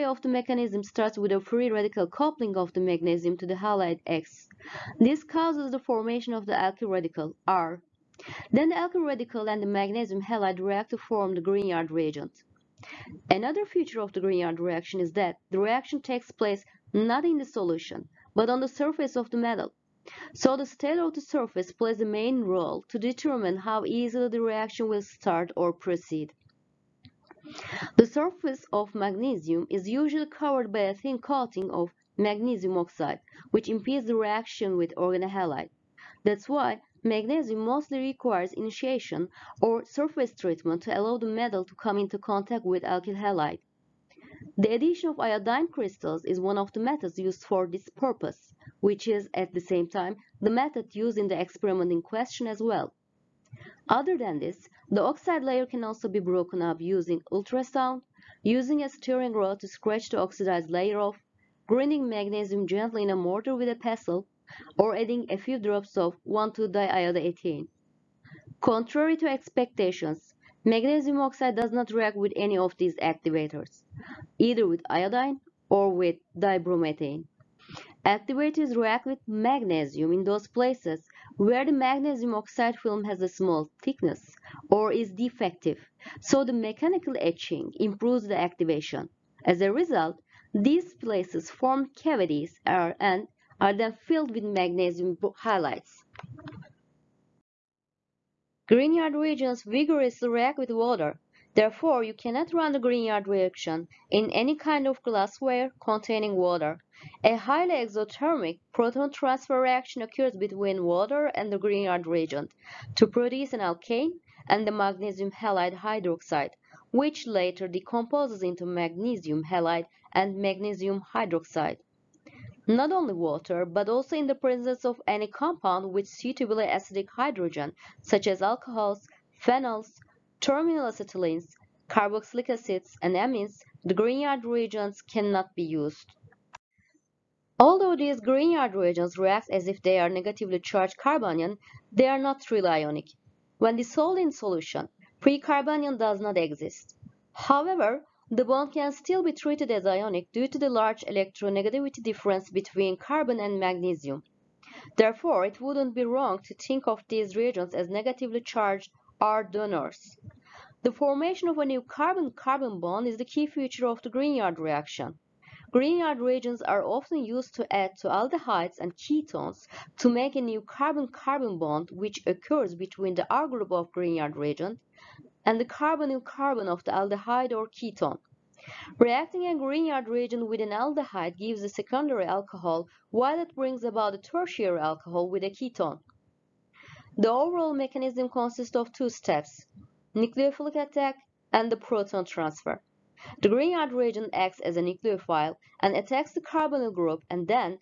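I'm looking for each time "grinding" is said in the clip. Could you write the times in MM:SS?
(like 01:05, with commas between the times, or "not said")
01:01.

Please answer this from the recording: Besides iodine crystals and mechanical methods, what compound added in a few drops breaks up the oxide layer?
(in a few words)
1,2-diiodoethane.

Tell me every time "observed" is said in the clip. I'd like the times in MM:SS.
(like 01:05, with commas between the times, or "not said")
not said.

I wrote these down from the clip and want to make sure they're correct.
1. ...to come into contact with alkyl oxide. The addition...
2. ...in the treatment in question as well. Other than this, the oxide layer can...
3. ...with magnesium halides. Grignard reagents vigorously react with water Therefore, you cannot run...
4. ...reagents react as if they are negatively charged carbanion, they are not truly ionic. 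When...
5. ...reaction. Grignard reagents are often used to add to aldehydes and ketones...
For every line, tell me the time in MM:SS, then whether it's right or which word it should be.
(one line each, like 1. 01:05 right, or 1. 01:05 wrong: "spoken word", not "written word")
1. 00:41 wrong: "halide", not "oxide"
2. 00:51 wrong: "experiment", not "treatment"
3. 01:34 right
4. 02:18 right
5. 02:44 right.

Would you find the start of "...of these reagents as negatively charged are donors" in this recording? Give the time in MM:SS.
02:36.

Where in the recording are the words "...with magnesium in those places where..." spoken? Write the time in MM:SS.
01:19.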